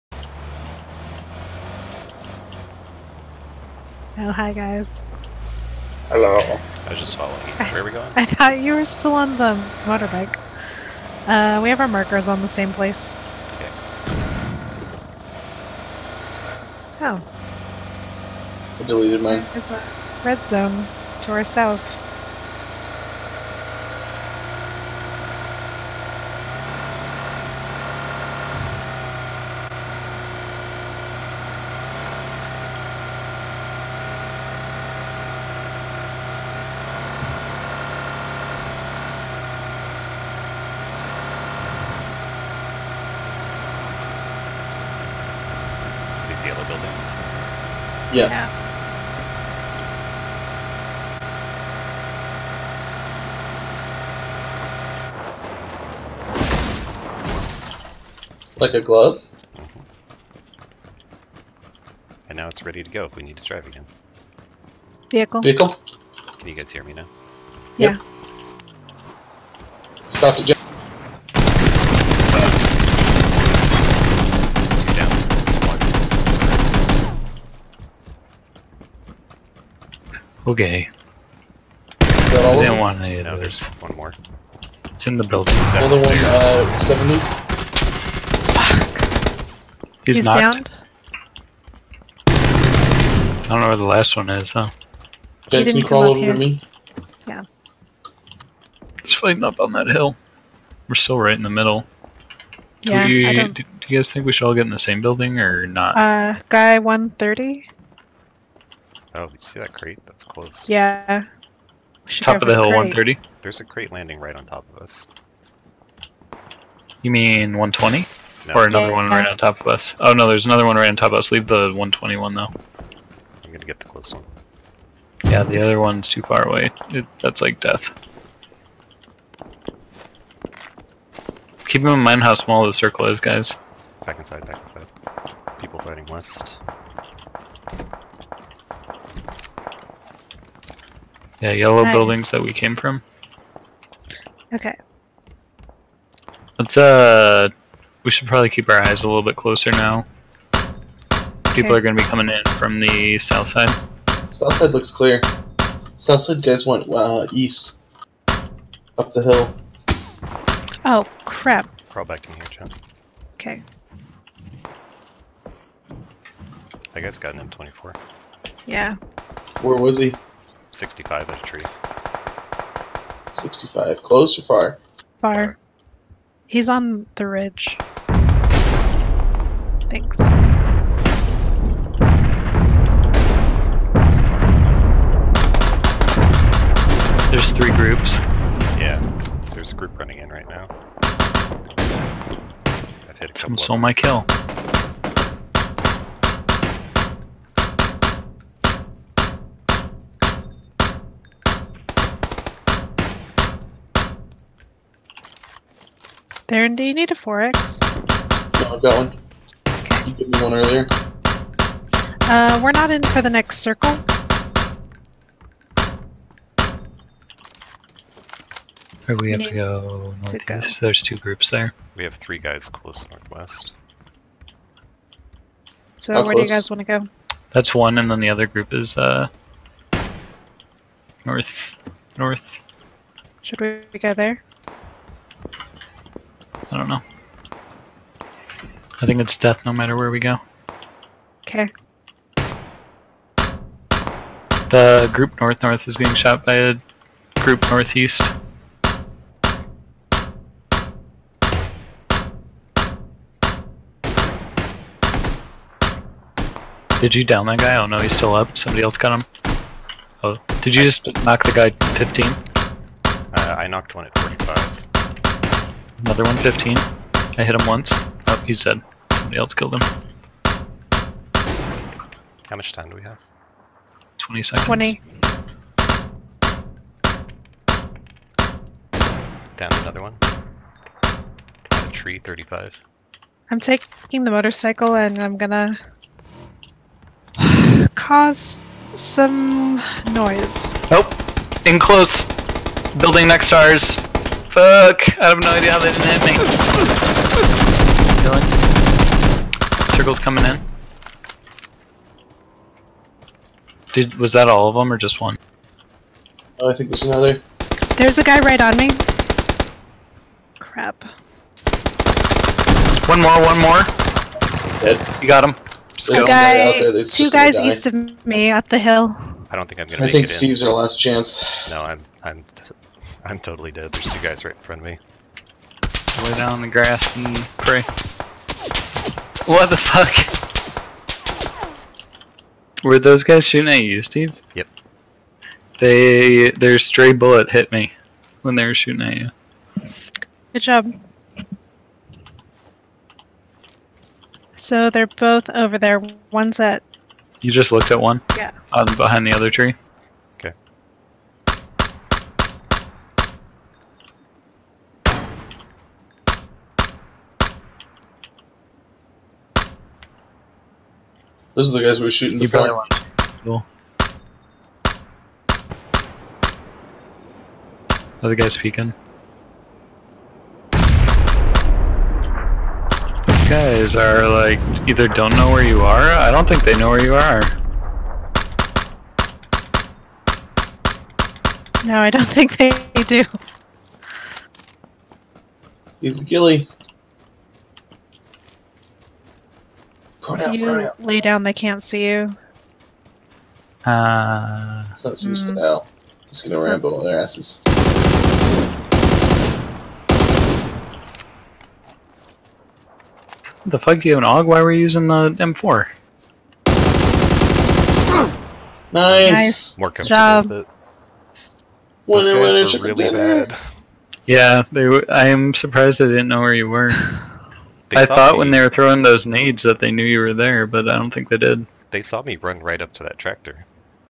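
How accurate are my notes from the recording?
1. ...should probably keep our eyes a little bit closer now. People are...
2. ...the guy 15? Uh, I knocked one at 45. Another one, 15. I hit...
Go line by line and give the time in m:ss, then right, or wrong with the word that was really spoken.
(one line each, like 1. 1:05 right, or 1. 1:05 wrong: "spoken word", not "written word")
1. 2:28 right
2. 4:21 right.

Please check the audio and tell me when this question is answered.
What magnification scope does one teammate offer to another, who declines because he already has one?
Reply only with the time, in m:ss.
3:27.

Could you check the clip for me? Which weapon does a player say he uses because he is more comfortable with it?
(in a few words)
M4.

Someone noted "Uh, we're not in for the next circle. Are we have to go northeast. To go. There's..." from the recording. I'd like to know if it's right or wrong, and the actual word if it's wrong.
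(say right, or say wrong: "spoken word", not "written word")
right.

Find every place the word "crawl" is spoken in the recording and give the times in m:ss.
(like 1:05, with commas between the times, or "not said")
1:35, 2:41.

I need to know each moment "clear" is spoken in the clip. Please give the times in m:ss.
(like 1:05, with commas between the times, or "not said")
2:34.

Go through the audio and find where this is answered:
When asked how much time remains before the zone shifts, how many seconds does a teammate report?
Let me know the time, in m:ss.
4:34.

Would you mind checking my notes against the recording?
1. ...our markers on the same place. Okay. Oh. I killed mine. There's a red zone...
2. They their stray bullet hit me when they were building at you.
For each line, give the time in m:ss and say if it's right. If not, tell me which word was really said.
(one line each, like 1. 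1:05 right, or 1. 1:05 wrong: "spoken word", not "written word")
1. 0:11 wrong: "deleted", not "killed"
2. 5:35 wrong: "shooting", not "building".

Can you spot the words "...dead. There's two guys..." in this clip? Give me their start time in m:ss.
5:23.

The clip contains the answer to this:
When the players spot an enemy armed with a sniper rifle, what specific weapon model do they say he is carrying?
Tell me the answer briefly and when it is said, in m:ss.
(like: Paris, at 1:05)
M24, at 2:47.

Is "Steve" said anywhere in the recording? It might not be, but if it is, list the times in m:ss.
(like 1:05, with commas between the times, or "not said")
5:20, 5:34.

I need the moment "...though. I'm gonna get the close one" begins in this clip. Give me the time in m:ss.
2:02.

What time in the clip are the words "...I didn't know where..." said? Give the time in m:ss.
6:56.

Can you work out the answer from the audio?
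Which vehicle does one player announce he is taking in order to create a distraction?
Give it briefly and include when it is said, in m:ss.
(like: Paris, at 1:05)
motorcycle, at 4:44.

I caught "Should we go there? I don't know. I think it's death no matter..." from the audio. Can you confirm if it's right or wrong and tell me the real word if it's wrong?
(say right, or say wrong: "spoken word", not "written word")
right.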